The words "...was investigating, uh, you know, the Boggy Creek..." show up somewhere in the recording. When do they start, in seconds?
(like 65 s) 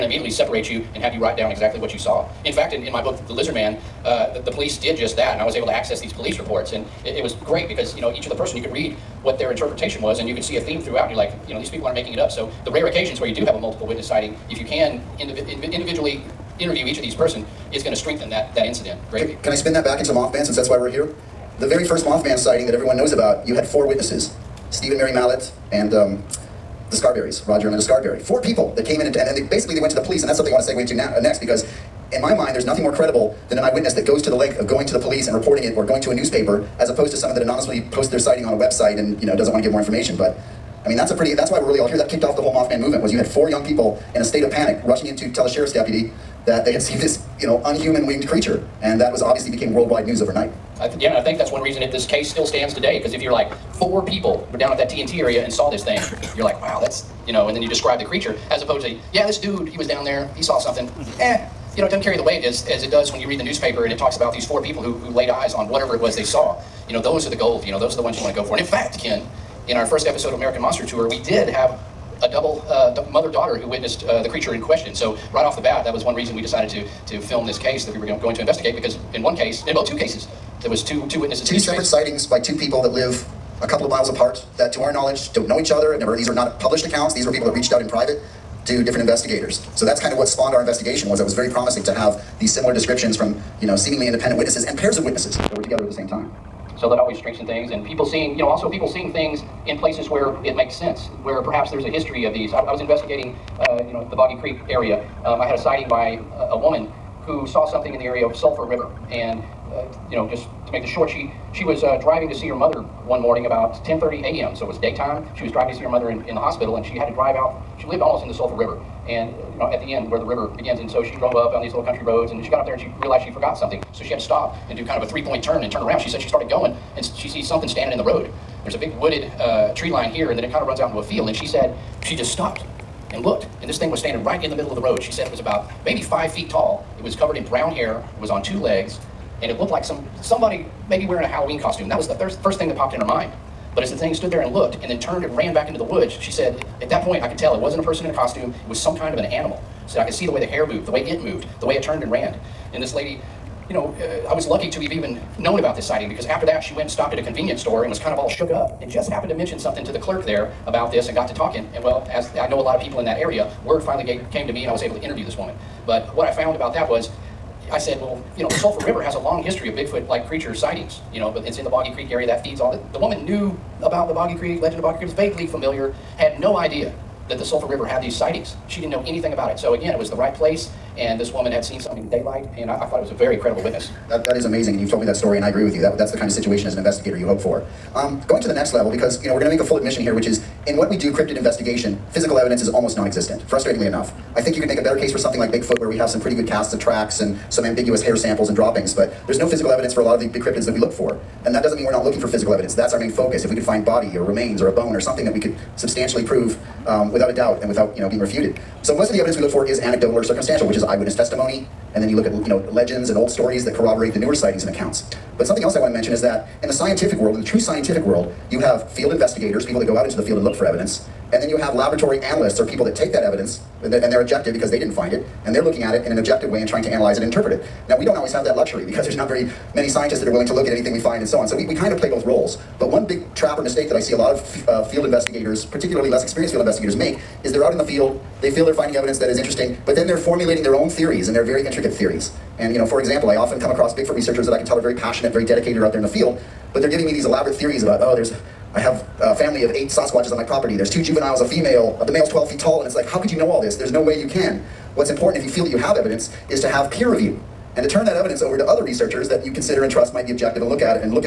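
102 s.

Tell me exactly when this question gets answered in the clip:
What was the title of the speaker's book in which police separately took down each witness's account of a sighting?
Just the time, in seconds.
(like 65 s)
3 s.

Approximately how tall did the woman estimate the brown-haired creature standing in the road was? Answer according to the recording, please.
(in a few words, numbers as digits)
5 feet.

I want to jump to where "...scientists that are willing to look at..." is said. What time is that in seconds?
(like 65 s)
229 s.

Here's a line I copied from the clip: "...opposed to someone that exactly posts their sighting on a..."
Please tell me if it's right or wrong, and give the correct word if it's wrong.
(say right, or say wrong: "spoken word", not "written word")
wrong: "anonymously", not "exactly".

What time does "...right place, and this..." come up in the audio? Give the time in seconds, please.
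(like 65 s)
180 s.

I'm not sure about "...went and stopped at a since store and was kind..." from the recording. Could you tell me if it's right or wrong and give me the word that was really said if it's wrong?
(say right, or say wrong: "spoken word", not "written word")
wrong: "convenience", not "since".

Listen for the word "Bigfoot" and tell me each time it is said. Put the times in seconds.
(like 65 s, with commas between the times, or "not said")
169 s, 195 s, 243 s.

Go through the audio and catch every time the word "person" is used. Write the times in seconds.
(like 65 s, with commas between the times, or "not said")
8 s, 17 s, 147 s.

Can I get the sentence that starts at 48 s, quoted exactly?
And that was obviously became worldwide news overnight.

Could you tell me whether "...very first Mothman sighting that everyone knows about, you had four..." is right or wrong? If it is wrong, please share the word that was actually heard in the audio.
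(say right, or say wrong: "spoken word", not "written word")
right.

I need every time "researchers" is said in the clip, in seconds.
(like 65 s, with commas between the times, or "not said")
244 s, 258 s.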